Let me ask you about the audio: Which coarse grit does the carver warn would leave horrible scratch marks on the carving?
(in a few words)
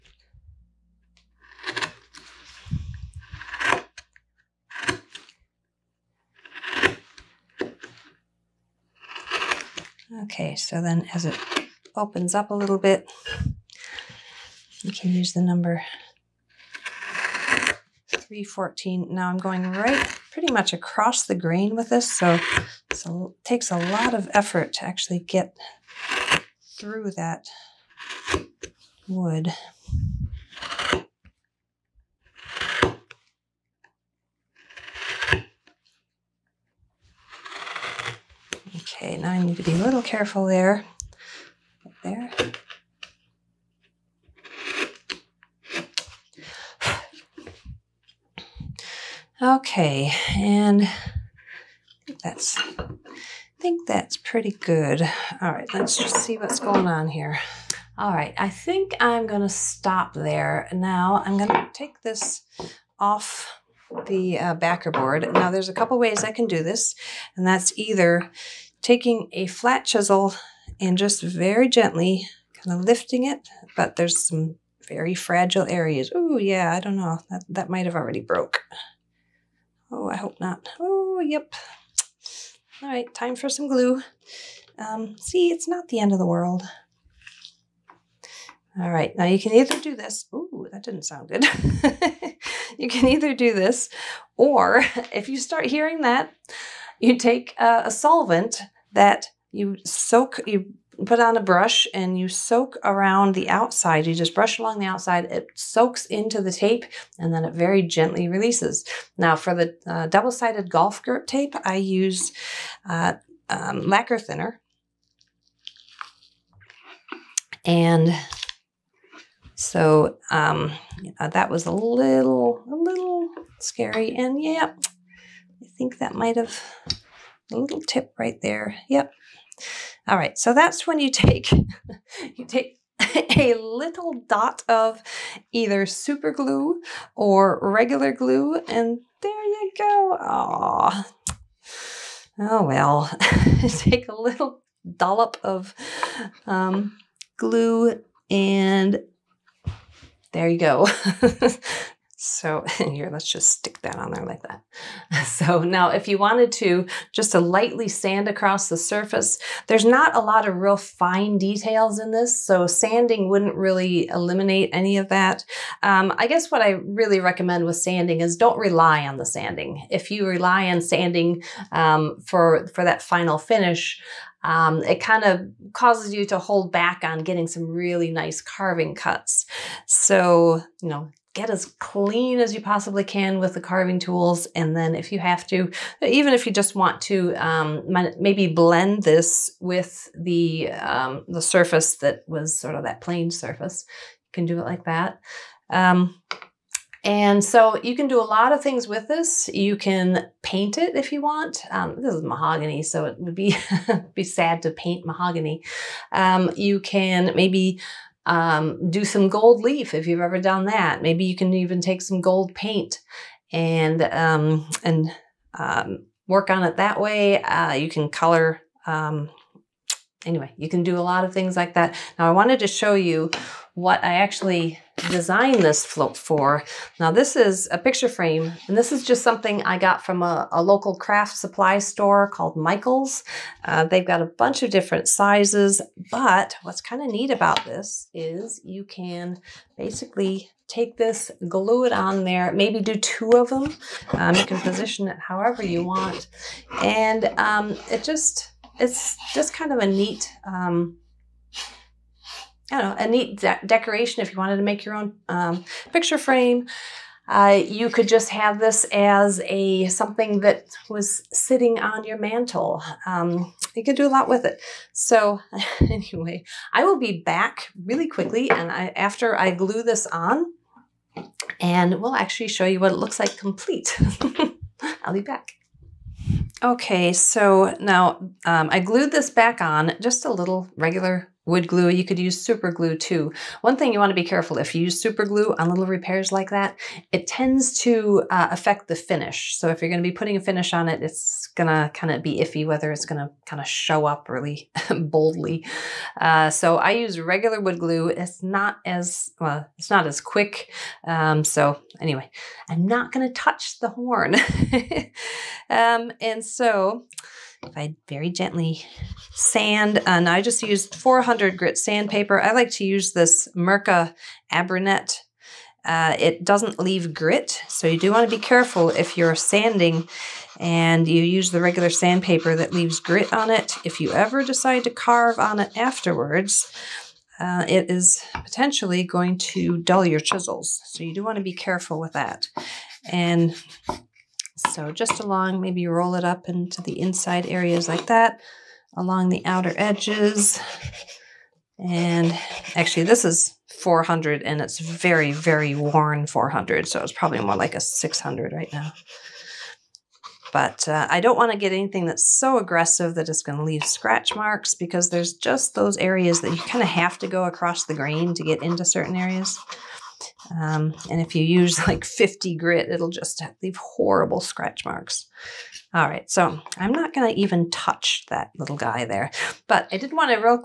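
50 grit.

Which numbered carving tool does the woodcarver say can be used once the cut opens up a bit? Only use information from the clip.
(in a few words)
314.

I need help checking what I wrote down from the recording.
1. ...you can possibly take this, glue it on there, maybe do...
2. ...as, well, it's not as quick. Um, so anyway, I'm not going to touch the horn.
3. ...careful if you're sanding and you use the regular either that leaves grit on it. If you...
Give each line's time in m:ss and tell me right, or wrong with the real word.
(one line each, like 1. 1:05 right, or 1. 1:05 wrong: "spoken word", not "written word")
1. 3:58 wrong: "basically", not "possibly"
2. 4:58 right
3. 5:18 wrong: "sandpaper", not "either".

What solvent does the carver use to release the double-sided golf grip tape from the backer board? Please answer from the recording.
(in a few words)
Lacquer thinner.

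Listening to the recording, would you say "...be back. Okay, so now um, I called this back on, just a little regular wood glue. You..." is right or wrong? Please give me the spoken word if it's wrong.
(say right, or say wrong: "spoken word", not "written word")
wrong: "glued", not "called".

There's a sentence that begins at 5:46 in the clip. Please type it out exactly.
So it's probably more like a 600 right now.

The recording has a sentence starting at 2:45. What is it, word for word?
Um, I guess what I really recommend with sanding is don't rely on the sanding.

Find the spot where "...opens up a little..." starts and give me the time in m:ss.
0:11.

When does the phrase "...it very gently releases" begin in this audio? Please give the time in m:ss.
1:47.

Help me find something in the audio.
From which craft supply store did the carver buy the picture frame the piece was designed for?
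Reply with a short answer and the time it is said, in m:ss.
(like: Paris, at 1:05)
Michael's, at 3:52.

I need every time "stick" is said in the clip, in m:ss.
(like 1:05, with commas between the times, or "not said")
2:33.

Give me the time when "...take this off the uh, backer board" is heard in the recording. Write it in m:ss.
1:01.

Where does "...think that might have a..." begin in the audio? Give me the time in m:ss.
2:05.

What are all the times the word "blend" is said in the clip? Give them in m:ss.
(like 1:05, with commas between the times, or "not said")
3:08.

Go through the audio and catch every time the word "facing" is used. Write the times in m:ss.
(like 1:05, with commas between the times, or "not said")
not said.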